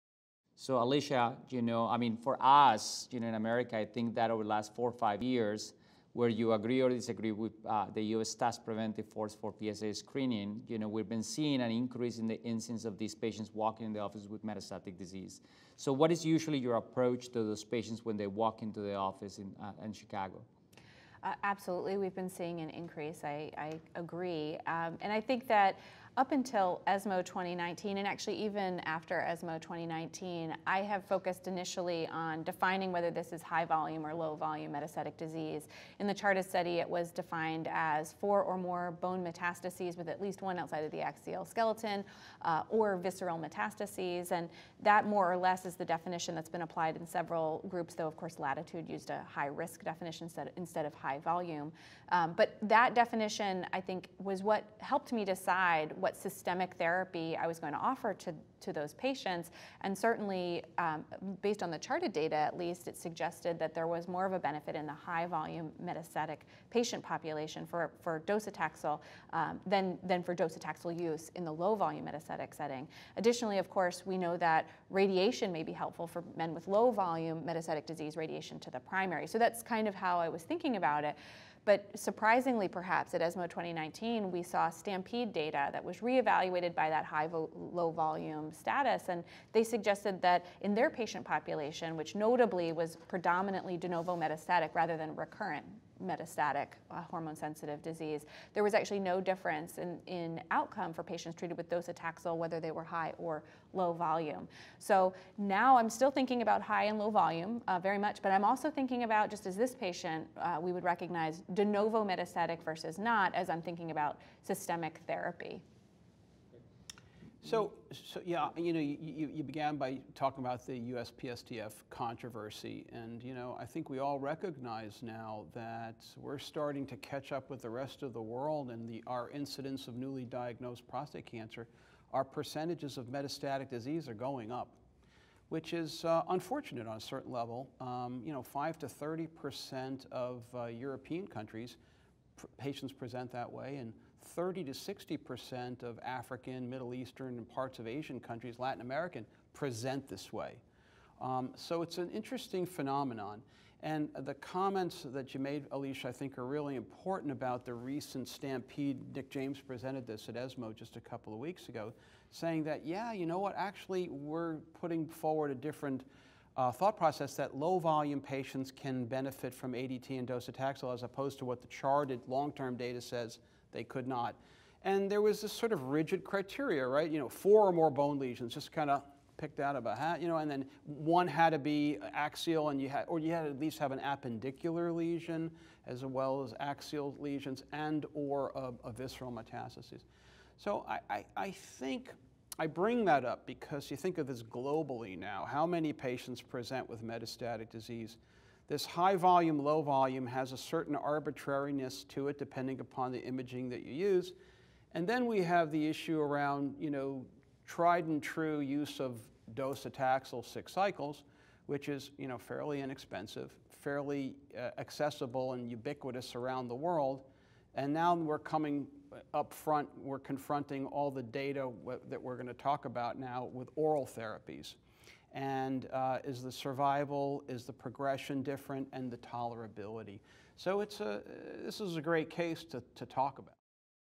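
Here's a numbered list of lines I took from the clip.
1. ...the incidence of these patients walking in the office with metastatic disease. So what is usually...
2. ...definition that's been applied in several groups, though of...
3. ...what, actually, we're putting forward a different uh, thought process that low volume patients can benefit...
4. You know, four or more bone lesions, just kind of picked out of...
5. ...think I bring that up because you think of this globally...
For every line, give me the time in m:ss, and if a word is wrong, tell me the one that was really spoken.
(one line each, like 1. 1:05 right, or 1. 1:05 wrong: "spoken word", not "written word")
1. 0:12 right
2. 0:45 right
3. 2:43 right
4. 2:57 right
5. 3:11 right.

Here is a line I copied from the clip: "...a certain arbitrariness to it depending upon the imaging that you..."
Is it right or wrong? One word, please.
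right.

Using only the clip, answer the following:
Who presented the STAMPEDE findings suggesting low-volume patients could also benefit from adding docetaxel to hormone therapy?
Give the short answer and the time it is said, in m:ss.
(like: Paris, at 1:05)
Nick James, at 2:39.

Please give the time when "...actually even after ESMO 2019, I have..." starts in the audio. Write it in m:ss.
0:28.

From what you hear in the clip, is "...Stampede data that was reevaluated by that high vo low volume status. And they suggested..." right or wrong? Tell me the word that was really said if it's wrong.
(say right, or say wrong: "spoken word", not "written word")
right.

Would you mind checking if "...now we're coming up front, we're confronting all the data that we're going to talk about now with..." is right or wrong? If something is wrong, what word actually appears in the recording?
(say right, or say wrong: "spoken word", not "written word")
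right.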